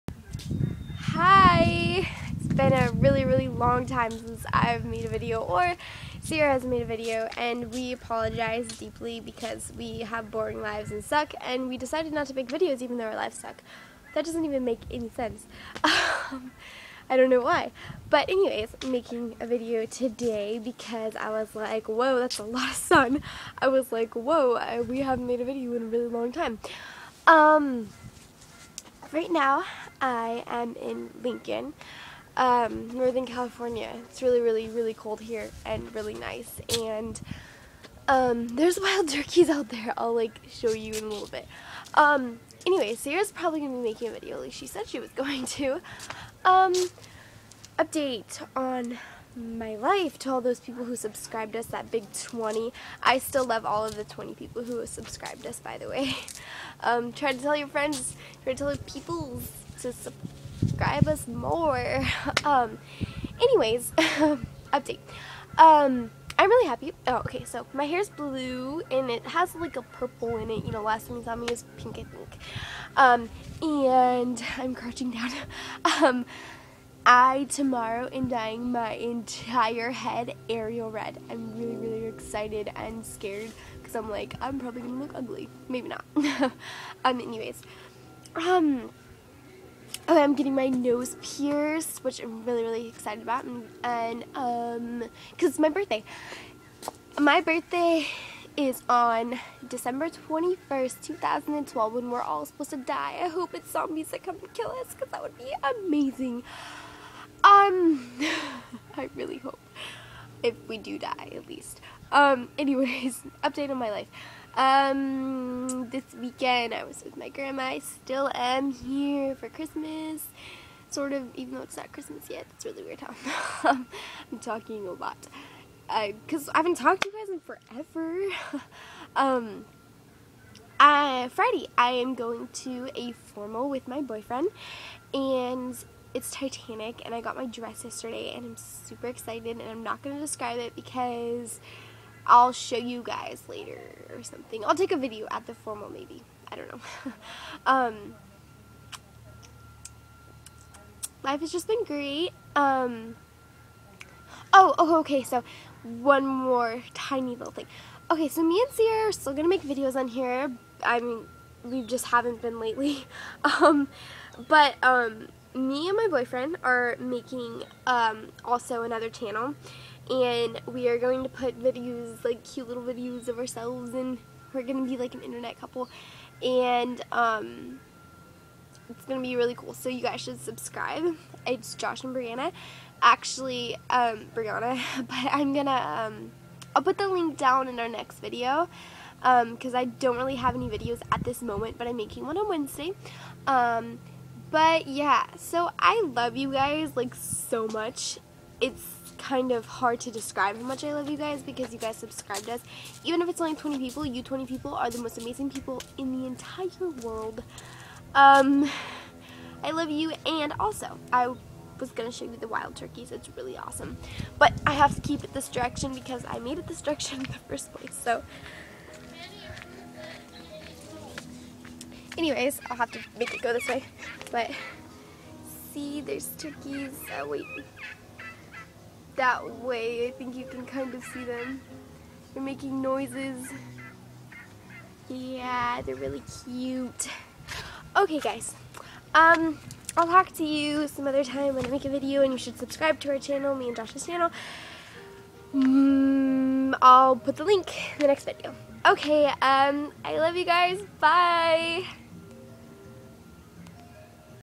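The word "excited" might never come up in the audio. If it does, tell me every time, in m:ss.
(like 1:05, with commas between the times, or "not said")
1:22, 1:32, 2:19.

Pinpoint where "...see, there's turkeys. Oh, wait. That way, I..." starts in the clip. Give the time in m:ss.
3:45.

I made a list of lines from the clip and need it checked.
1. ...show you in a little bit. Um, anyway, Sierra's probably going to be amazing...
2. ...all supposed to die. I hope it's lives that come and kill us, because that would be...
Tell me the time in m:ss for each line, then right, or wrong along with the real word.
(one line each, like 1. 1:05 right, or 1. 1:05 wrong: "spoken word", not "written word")
1. 0:40 wrong: "making", not "amazing"
2. 1:42 wrong: "zombies", not "lives".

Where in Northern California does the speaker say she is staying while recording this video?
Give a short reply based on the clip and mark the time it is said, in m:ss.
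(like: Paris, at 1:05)
Lincoln, at 0:31.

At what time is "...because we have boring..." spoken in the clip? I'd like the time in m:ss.
0:09.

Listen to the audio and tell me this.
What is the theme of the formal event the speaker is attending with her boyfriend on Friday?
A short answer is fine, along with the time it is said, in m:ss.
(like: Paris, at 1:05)
Titanic, at 2:16.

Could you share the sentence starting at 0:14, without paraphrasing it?
That doesn't even make any sense.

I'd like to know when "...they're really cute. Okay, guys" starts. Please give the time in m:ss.
3:55.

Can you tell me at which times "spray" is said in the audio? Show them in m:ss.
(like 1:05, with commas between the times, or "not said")
not said.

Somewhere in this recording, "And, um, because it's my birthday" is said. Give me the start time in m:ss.
1:33.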